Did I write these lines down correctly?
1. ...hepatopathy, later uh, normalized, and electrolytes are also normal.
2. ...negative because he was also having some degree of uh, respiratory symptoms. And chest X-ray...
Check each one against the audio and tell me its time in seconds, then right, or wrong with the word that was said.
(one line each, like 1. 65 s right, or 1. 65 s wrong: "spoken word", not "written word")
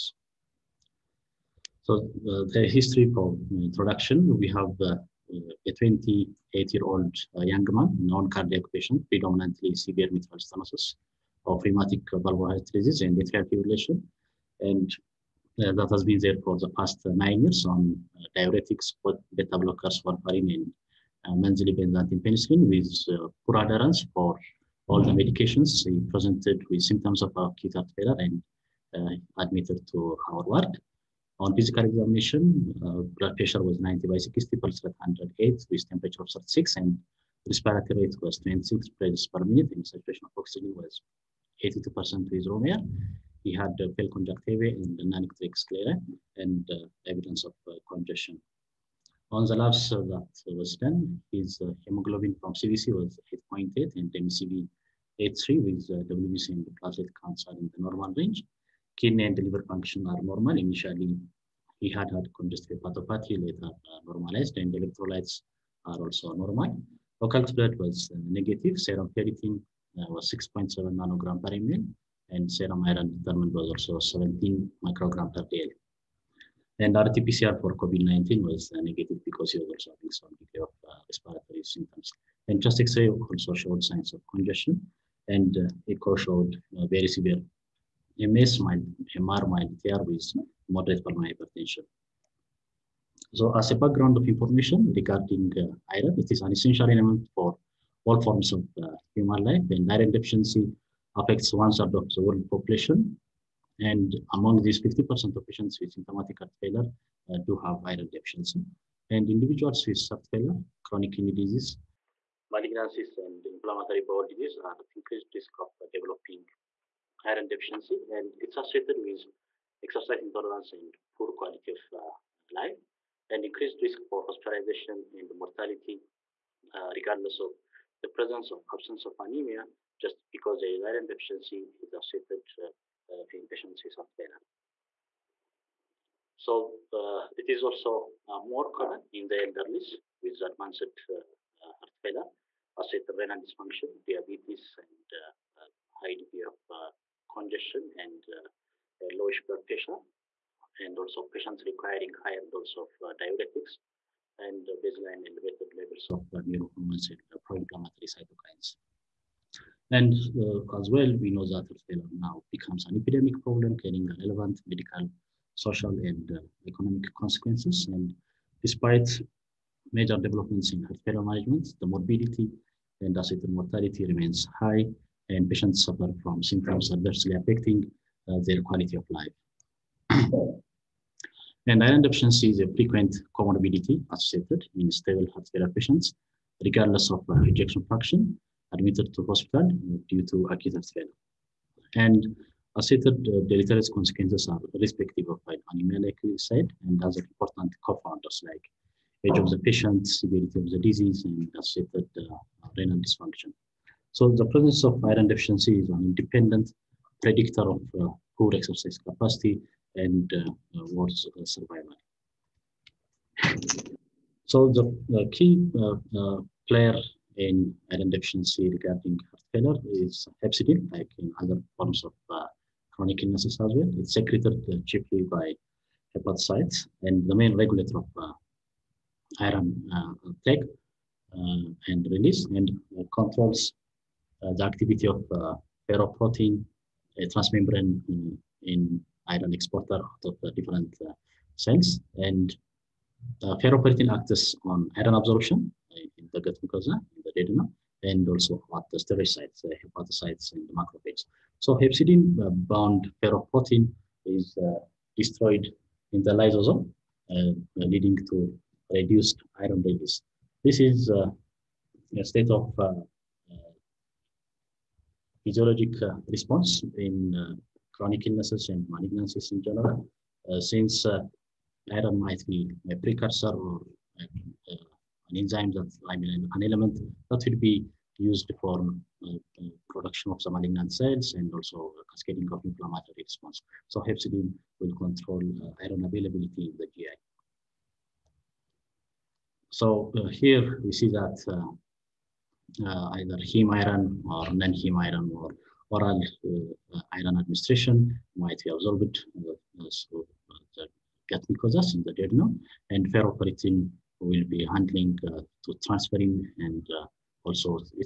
1. 62 s right
2. 78 s right.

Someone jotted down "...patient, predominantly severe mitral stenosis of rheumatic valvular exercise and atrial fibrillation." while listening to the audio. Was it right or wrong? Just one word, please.
wrong.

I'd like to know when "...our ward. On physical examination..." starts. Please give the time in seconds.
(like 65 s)
30 s.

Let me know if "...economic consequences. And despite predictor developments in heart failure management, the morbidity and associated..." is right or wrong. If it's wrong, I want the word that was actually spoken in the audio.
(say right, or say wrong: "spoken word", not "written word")
wrong: "major", not "predictor".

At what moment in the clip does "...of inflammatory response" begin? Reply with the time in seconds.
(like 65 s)
282 s.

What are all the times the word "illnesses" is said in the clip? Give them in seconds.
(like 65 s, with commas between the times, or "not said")
223 s, 268 s.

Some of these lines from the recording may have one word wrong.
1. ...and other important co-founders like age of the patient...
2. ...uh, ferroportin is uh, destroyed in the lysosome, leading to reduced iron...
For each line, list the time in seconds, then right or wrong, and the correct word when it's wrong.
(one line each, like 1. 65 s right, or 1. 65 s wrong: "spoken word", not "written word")
1. 196 s right
2. 253 s right.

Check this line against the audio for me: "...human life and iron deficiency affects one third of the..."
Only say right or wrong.
right.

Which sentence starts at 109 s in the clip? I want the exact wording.
And individuals with heart failure, chronic kidney disease, malignancies, and inflammatory bowel disease are at increased risk of uh, developing iron deficiency.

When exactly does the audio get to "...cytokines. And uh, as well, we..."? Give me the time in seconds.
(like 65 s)
158 s.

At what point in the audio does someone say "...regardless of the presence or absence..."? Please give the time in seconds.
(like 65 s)
126 s.